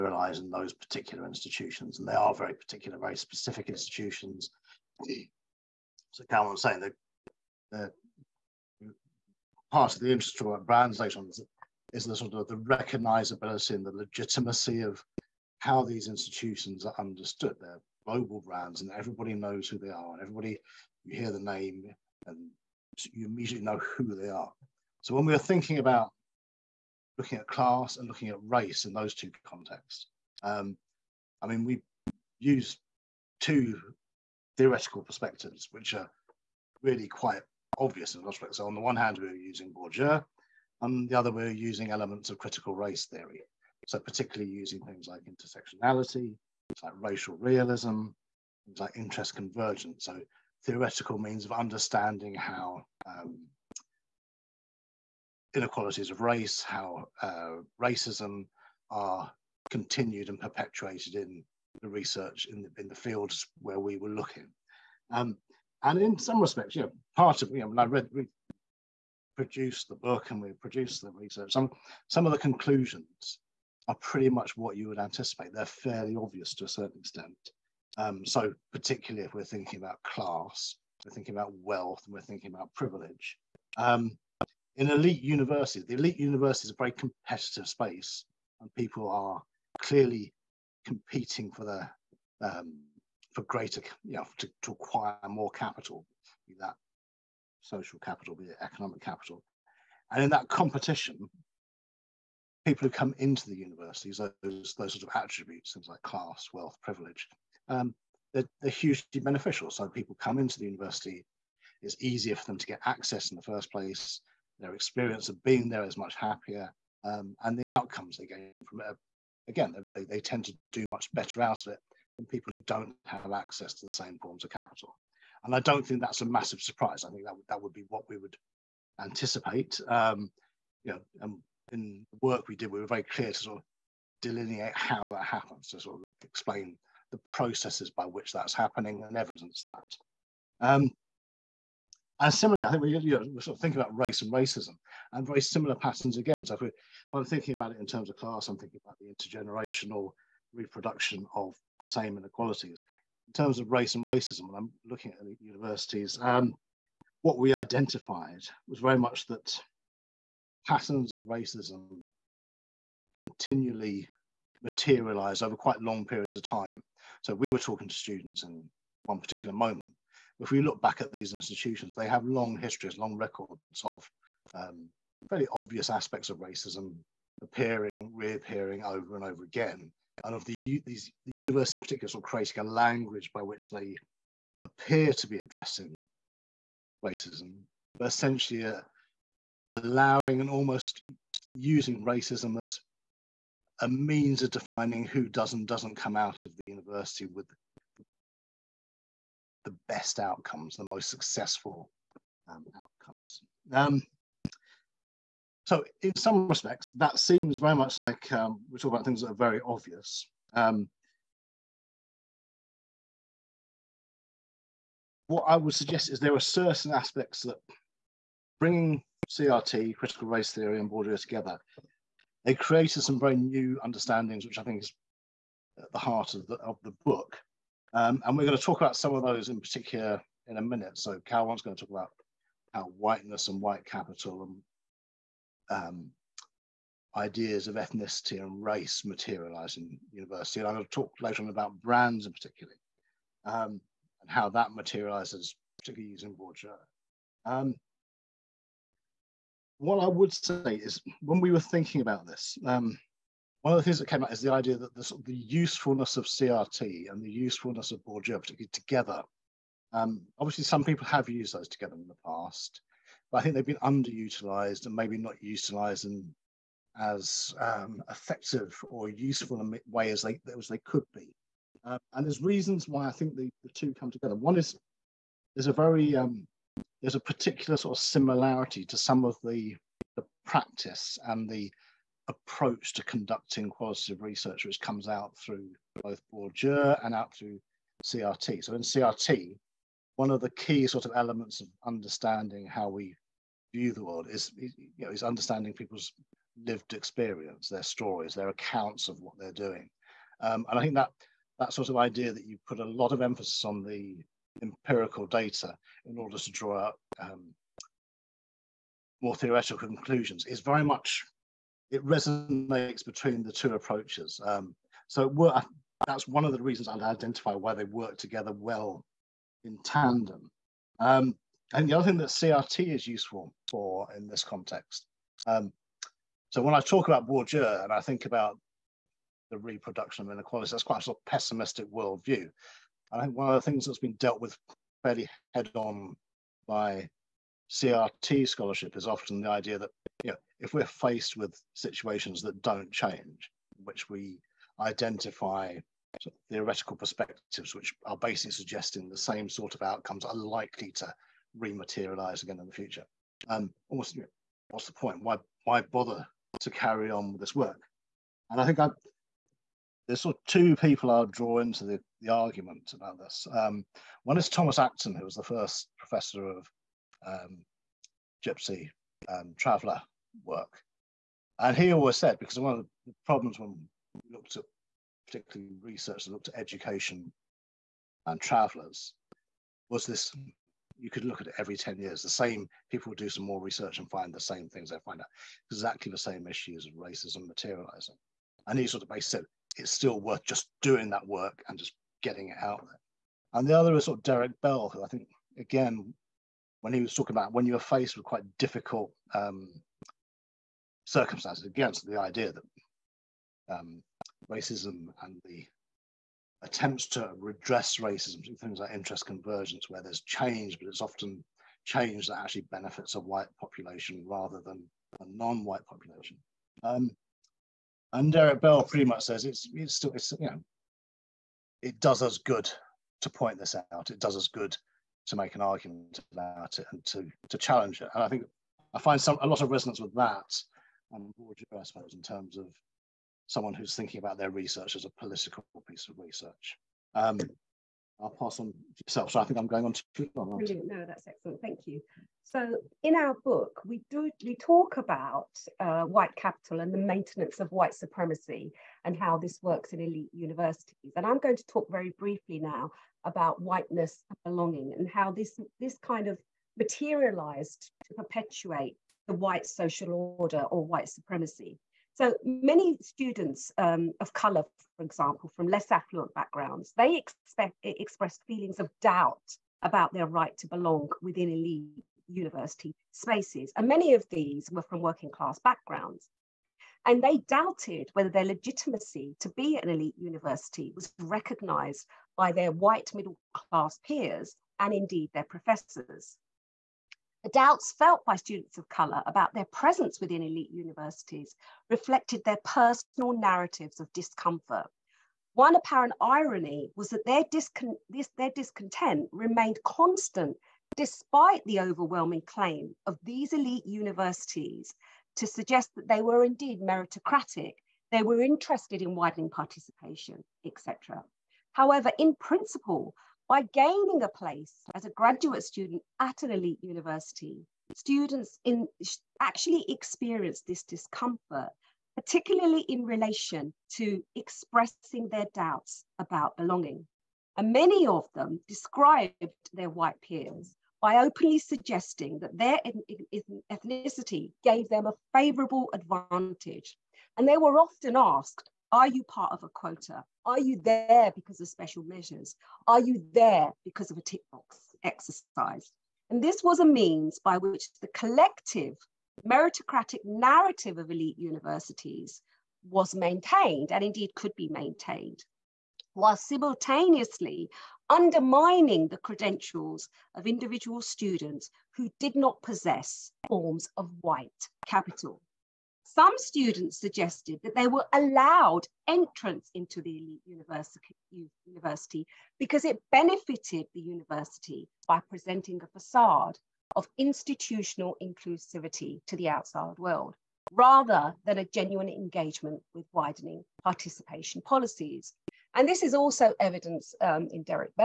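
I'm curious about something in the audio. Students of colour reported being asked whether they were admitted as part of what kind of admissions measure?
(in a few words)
A quota.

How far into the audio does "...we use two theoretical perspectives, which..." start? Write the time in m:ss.
0:31.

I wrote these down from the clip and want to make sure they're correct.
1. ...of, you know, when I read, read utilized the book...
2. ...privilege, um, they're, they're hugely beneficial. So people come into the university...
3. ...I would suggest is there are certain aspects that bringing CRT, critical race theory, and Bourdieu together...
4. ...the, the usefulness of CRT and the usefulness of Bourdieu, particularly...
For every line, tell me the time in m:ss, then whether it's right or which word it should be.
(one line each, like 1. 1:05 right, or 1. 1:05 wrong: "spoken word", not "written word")
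1. 1:07 wrong: "produced", not "utilized"
2. 1:46 right
3. 3:35 right
4. 4:14 right.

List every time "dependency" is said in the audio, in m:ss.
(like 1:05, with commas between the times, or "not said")
not said.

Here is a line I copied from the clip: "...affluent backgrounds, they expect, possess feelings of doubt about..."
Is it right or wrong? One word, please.
wrong.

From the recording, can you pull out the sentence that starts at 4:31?
Uh, and there's reasons why I think the, the two come together.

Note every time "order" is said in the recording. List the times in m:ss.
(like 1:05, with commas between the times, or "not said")
5:06, 7:40.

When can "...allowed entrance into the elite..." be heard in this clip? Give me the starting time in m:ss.
9:28.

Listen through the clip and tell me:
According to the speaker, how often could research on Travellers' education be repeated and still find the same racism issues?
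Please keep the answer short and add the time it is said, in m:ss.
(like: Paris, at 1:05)
Every 10 years, at 6:21.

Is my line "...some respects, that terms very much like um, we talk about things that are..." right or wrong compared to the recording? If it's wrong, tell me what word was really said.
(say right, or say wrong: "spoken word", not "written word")
wrong: "seems", not "terms".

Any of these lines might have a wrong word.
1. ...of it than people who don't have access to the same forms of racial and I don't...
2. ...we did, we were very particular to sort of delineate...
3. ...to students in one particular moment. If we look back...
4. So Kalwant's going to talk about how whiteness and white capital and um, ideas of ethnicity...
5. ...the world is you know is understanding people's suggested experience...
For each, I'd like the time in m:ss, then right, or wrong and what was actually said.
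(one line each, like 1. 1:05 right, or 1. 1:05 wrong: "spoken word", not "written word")
1. 2:01 wrong: "capital", not "racial"
2. 2:12 wrong: "clear", not "particular"
3. 2:47 right
4. 3:50 right
5. 4:53 wrong: "lived", not "suggested".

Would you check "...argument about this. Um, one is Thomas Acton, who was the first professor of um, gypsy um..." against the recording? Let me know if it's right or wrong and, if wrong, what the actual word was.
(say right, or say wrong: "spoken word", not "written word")
right.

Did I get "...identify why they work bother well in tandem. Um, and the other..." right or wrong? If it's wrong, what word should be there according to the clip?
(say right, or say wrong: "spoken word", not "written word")
wrong: "together", not "bother".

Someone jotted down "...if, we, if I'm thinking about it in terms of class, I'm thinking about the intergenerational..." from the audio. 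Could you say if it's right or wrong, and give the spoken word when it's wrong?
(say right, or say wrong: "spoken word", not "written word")
right.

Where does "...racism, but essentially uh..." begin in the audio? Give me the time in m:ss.
3:07.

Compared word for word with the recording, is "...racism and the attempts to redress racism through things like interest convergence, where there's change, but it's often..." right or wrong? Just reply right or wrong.
right.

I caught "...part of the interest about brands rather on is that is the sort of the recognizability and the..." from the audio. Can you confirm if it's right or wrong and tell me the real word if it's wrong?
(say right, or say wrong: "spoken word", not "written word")
wrong: "later", not "rather".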